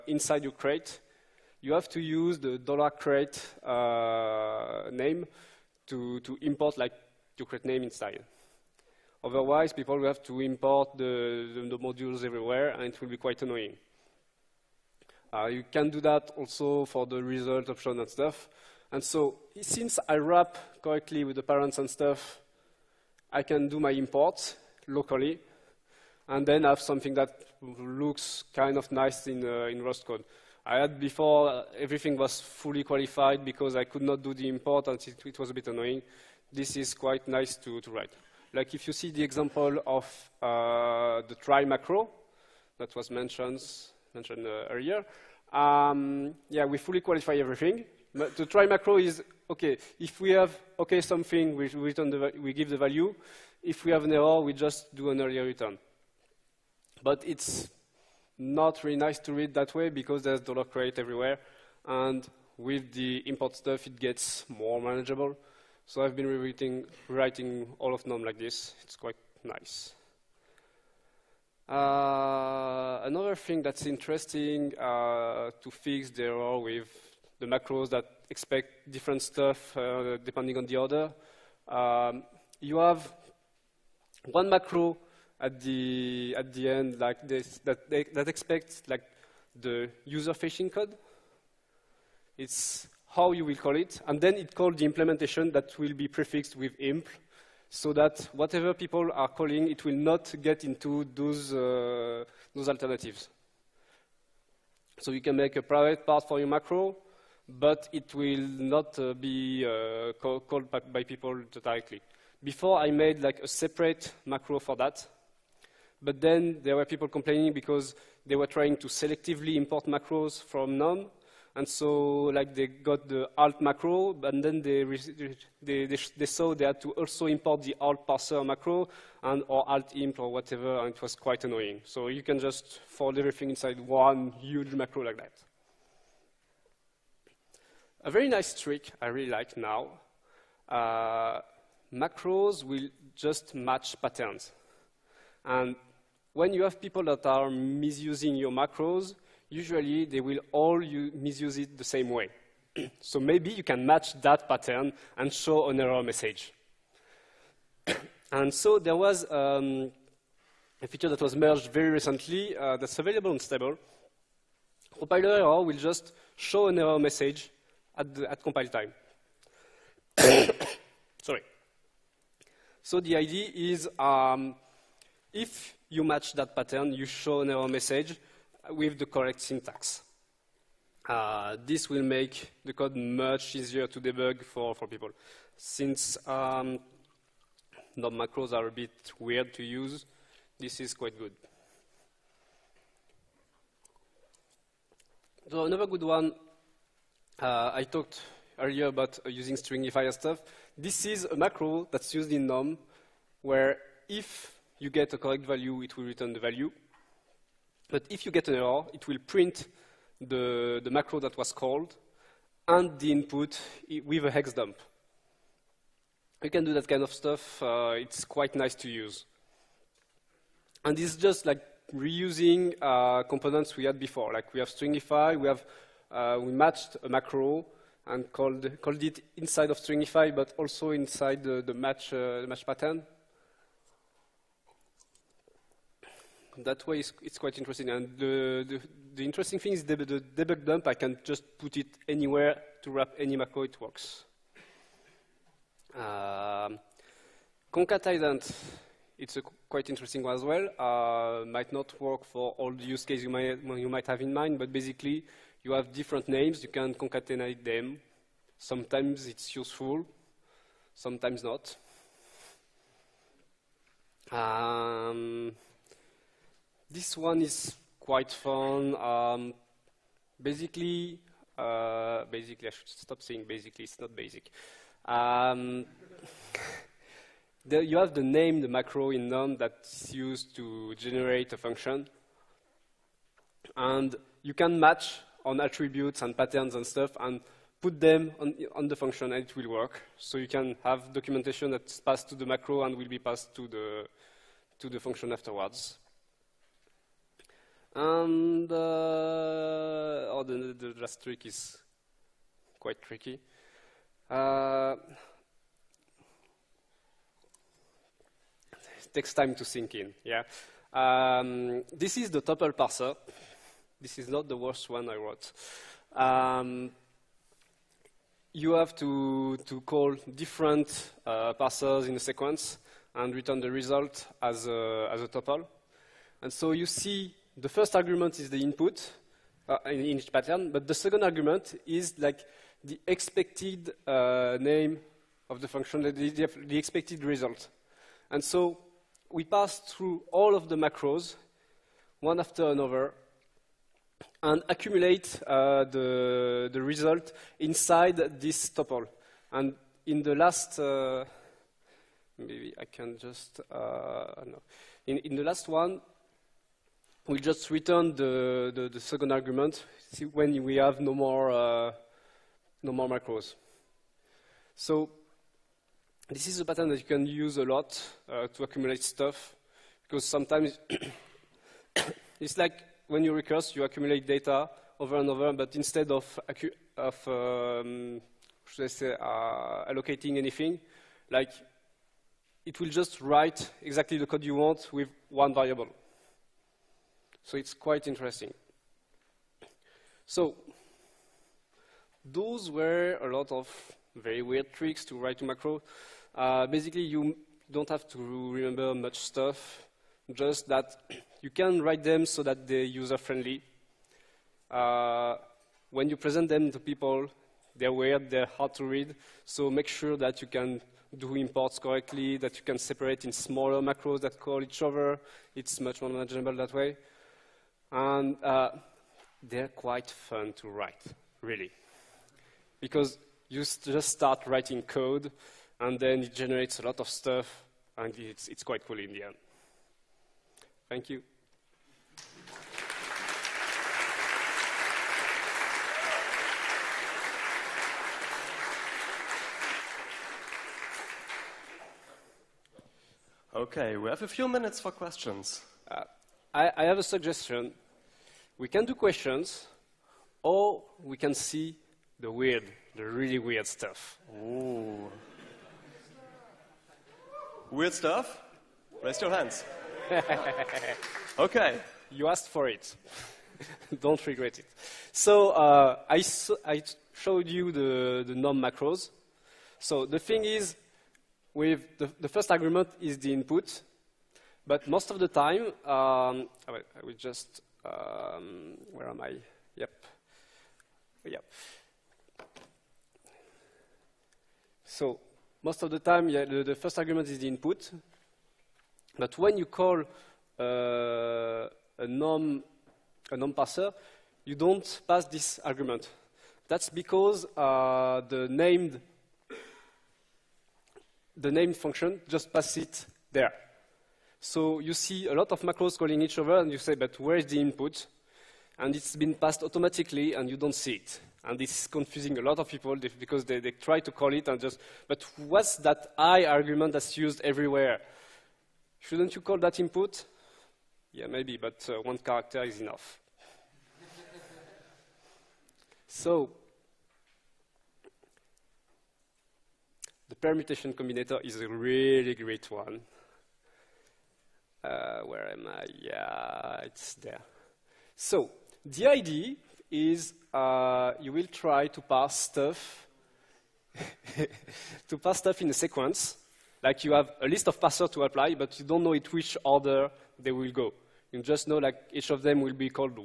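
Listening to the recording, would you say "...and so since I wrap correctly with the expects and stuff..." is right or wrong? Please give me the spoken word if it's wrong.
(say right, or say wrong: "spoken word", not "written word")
wrong: "parents", not "expects".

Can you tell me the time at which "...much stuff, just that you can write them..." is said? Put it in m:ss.
6:38.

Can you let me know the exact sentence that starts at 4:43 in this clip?
And you can match on attributes and patterns and stuff and put them on, on, the function and it will work.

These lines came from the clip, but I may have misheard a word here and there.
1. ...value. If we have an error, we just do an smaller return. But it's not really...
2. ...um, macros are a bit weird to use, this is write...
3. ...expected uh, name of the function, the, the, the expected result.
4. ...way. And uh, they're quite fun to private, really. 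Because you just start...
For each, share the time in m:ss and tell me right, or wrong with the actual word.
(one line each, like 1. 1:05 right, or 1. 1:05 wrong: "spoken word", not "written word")
1. 0:52 wrong: "earlier", not "smaller"
2. 3:06 wrong: "quite", not "write"
3. 5:33 right
4. 6:56 wrong: "write", not "private".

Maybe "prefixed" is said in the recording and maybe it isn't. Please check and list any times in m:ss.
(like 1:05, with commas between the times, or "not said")
1:36.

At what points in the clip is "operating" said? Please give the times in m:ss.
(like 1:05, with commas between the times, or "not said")
not said.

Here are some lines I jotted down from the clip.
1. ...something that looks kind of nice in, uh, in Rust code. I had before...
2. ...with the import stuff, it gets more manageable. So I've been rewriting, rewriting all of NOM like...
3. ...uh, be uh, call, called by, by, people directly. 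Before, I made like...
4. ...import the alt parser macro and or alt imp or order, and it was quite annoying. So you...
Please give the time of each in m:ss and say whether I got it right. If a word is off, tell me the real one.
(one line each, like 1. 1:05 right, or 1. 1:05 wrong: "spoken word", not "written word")
1. 0:26 right
2. 1:02 right
3. 1:48 right
4. 2:07 wrong: "whatever", not "order".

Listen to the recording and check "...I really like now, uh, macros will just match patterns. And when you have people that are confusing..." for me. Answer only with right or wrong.
wrong.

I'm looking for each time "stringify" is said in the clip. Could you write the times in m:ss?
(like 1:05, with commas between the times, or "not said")
3:19, 3:44, 3:49.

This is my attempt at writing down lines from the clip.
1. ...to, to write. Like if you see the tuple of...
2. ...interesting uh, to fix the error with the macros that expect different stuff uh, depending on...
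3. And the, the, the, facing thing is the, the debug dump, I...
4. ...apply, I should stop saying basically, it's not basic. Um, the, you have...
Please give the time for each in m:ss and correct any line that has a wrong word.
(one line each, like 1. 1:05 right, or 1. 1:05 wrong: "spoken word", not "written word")
1. 0:37 wrong: "example", not "tuple"
2. 1:13 right
3. 3:57 wrong: "interesting", not "facing"
4. 4:32 wrong: "basically", not "apply".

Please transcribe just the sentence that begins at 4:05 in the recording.
Uh, um, concatenant, it's a quite interesting one as well.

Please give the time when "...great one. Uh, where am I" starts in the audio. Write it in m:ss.
8:52.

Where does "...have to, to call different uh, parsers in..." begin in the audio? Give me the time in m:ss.
5:18.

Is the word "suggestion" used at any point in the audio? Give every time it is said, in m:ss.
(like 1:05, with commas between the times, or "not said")
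7:27.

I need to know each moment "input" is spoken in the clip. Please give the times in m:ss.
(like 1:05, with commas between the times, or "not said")
3:33, 5:28, 7:53, 8:07, 8:27, 8:39.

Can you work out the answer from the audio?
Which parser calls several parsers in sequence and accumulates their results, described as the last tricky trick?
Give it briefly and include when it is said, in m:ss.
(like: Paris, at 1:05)
tuple parser, at 5:12.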